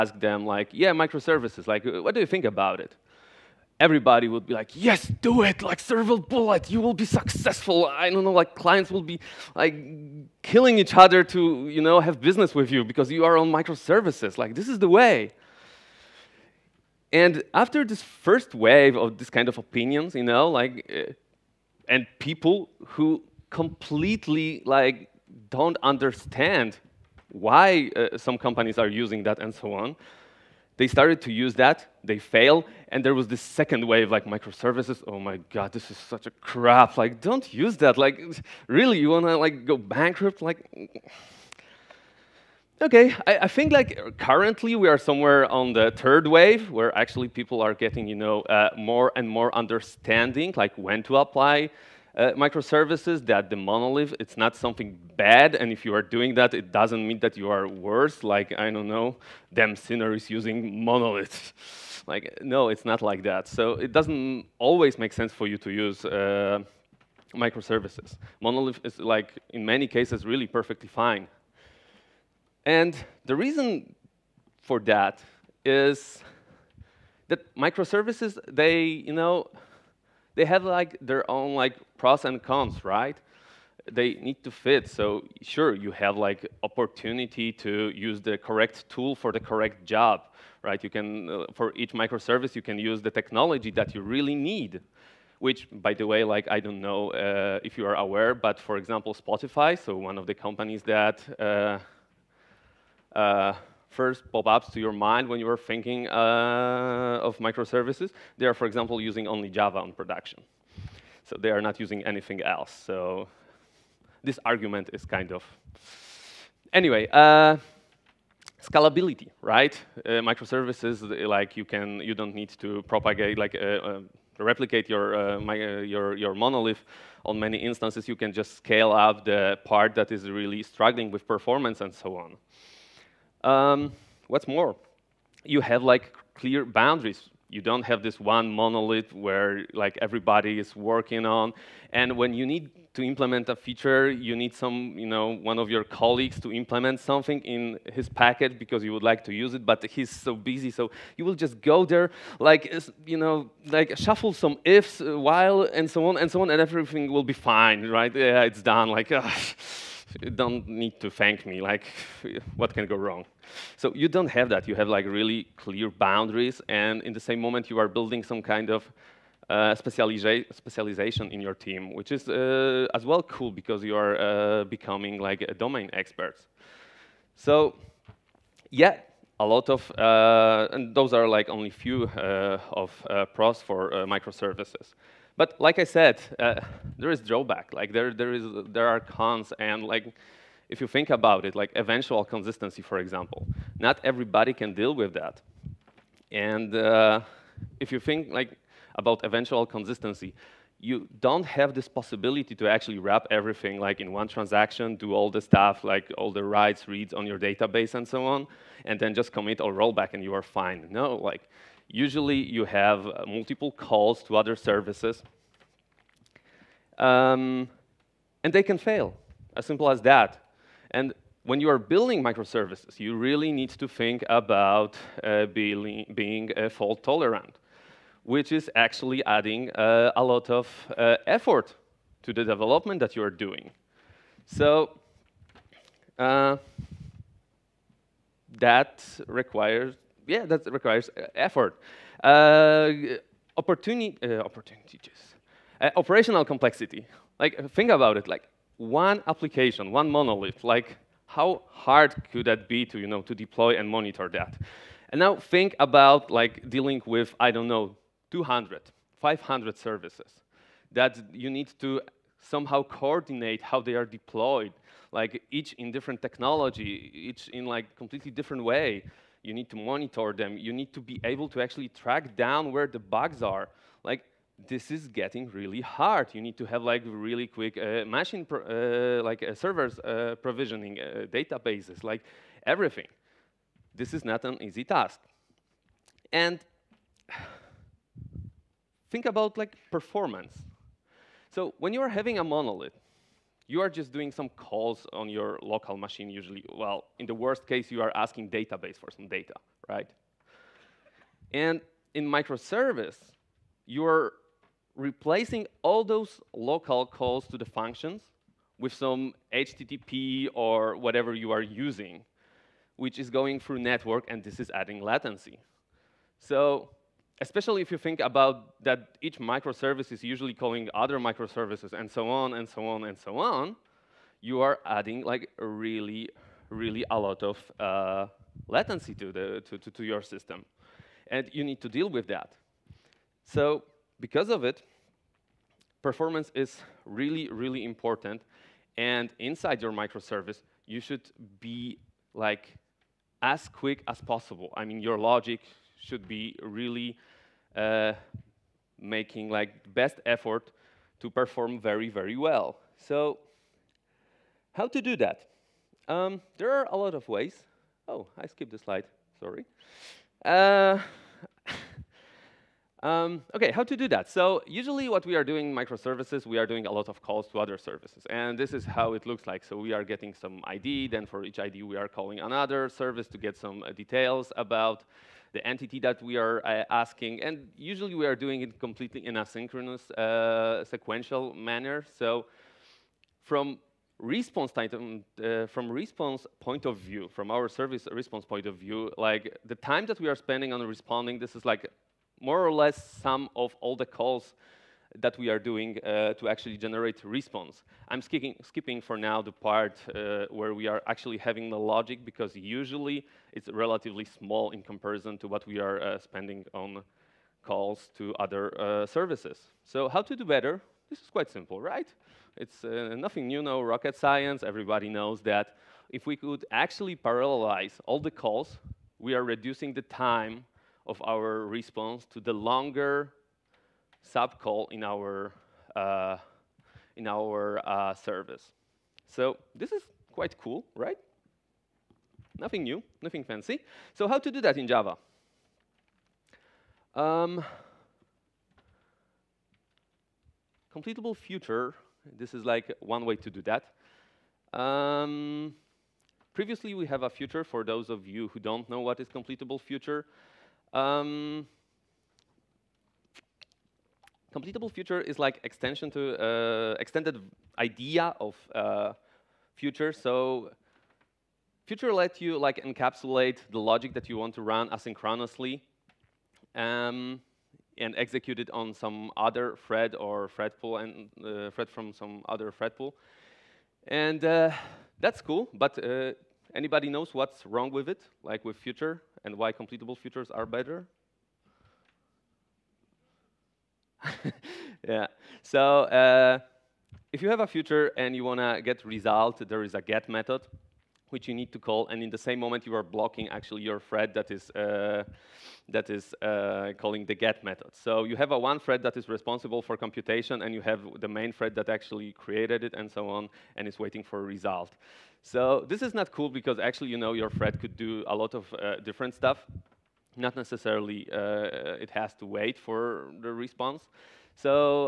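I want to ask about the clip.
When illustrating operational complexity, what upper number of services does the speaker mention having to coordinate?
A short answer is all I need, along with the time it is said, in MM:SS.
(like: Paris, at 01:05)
500, at 04:19.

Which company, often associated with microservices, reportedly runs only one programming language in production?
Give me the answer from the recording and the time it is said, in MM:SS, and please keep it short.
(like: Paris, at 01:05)
Spotify, at 01:39.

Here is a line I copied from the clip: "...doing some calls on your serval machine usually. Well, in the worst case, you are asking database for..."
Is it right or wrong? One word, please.
wrong.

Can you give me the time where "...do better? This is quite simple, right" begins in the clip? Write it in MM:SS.
06:50.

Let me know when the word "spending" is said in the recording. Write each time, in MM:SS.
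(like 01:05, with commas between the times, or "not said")
06:30, 06:46.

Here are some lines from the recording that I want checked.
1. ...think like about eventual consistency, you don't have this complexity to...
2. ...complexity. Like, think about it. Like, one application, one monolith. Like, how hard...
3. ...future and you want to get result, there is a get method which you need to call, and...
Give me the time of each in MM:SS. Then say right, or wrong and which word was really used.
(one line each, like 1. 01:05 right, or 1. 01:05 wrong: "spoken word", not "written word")
1. 03:18 wrong: "possibility", not "complexity"
2. 04:06 right
3. 08:07 right.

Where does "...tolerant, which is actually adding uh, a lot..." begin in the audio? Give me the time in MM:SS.
03:47.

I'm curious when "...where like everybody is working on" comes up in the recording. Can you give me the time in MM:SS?
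02:19.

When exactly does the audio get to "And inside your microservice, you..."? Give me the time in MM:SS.
05:38.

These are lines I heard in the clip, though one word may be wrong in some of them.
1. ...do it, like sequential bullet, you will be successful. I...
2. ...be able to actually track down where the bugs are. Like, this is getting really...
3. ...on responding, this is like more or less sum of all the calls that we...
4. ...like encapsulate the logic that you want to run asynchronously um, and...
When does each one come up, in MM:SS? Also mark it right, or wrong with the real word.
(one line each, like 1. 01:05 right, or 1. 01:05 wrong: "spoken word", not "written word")
1. 00:05 wrong: "serval", not "sequential"
2. 04:30 right
3. 06:30 right
4. 07:42 right.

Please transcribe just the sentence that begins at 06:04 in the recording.
So usually what we are doing microservices, we are doing a lot of calls to other services.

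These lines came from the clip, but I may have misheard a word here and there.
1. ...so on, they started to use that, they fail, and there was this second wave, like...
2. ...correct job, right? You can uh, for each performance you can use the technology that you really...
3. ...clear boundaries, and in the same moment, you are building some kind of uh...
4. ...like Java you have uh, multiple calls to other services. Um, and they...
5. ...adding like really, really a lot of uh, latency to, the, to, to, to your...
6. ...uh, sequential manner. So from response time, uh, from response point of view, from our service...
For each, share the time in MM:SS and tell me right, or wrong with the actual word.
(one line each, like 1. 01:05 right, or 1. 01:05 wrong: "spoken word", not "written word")
1. 00:29 right
2. 01:29 wrong: "microservice", not "performance"
3. 02:45 right
4. 03:31 wrong: "Usually", not "Java"
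5. 05:24 right
6. 06:20 right.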